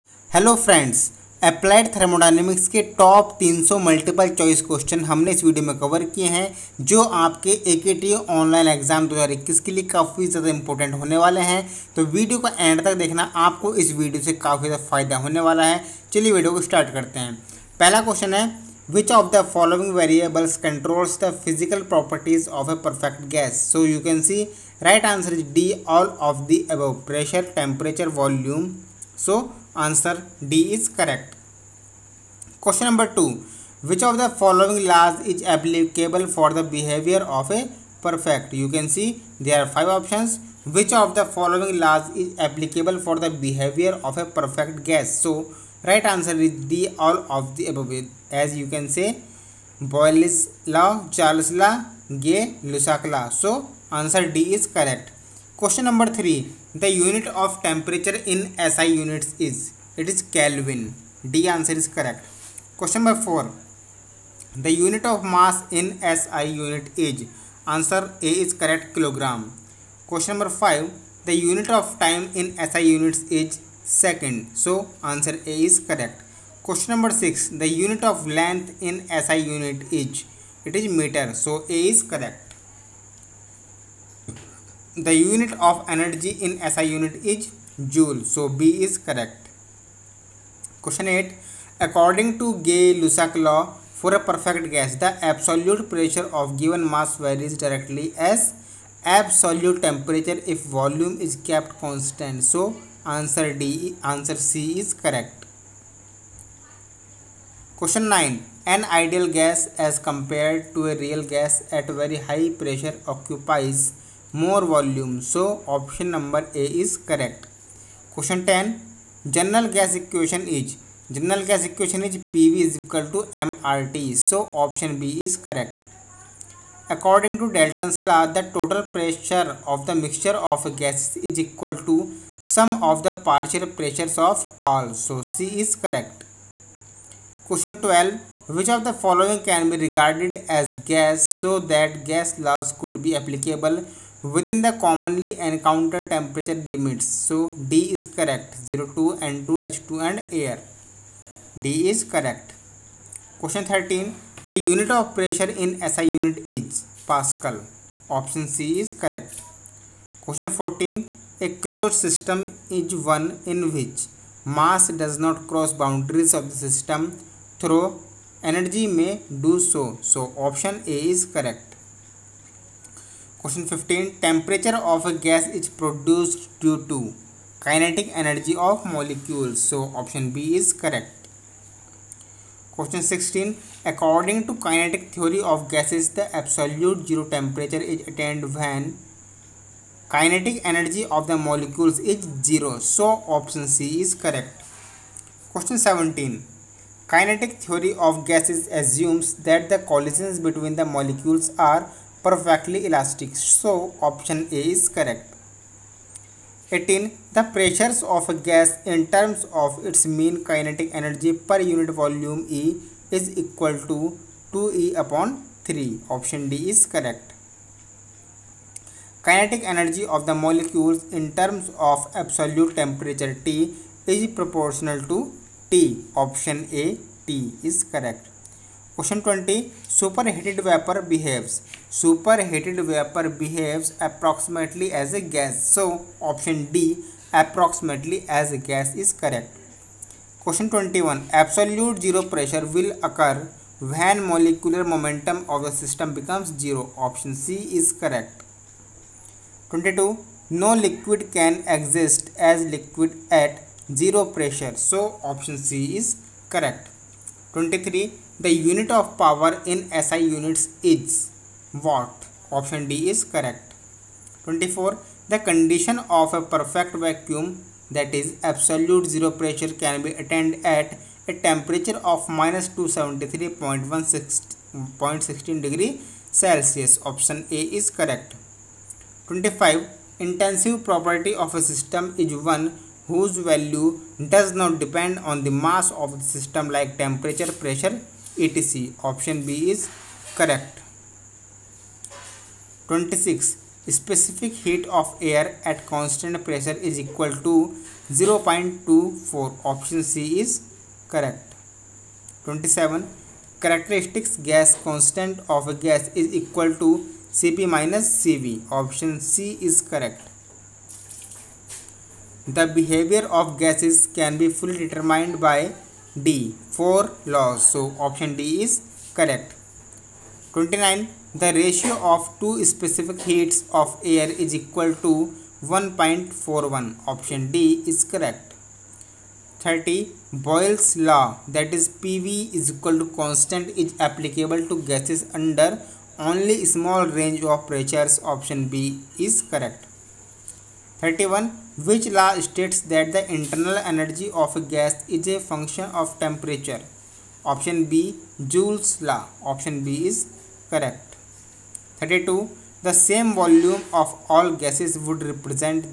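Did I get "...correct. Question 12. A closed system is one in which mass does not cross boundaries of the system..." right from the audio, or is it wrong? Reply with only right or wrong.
wrong.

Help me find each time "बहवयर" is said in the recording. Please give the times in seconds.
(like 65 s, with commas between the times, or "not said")
36 s, 43 s.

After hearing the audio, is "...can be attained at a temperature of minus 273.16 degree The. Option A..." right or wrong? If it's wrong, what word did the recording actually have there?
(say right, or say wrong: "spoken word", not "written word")
wrong: "Celsius", not "The".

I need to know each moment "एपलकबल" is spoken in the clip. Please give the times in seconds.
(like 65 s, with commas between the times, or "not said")
35 s, 42 s.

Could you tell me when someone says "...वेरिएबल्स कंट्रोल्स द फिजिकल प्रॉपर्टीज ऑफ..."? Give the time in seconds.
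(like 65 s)
19 s.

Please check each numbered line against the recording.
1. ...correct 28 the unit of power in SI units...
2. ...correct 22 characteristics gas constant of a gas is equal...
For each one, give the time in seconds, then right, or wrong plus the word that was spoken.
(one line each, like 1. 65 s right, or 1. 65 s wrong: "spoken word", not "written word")
1. 256 s wrong: "23", not "28"
2. 301 s wrong: "27", not "22".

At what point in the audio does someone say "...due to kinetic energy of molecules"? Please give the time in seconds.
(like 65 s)
176 s.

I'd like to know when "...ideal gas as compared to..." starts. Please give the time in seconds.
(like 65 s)
108 s.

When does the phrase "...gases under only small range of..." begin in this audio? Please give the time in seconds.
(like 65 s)
334 s.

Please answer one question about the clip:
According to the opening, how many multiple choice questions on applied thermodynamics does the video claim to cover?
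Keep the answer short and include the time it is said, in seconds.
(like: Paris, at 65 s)
300, at 3 s.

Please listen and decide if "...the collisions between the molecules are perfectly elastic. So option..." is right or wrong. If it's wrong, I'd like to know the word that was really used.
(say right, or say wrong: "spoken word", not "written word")
right.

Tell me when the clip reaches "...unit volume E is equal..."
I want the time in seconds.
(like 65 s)
211 s.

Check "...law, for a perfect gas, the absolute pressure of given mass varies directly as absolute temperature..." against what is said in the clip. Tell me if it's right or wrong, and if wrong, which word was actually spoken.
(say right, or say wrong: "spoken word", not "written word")
right.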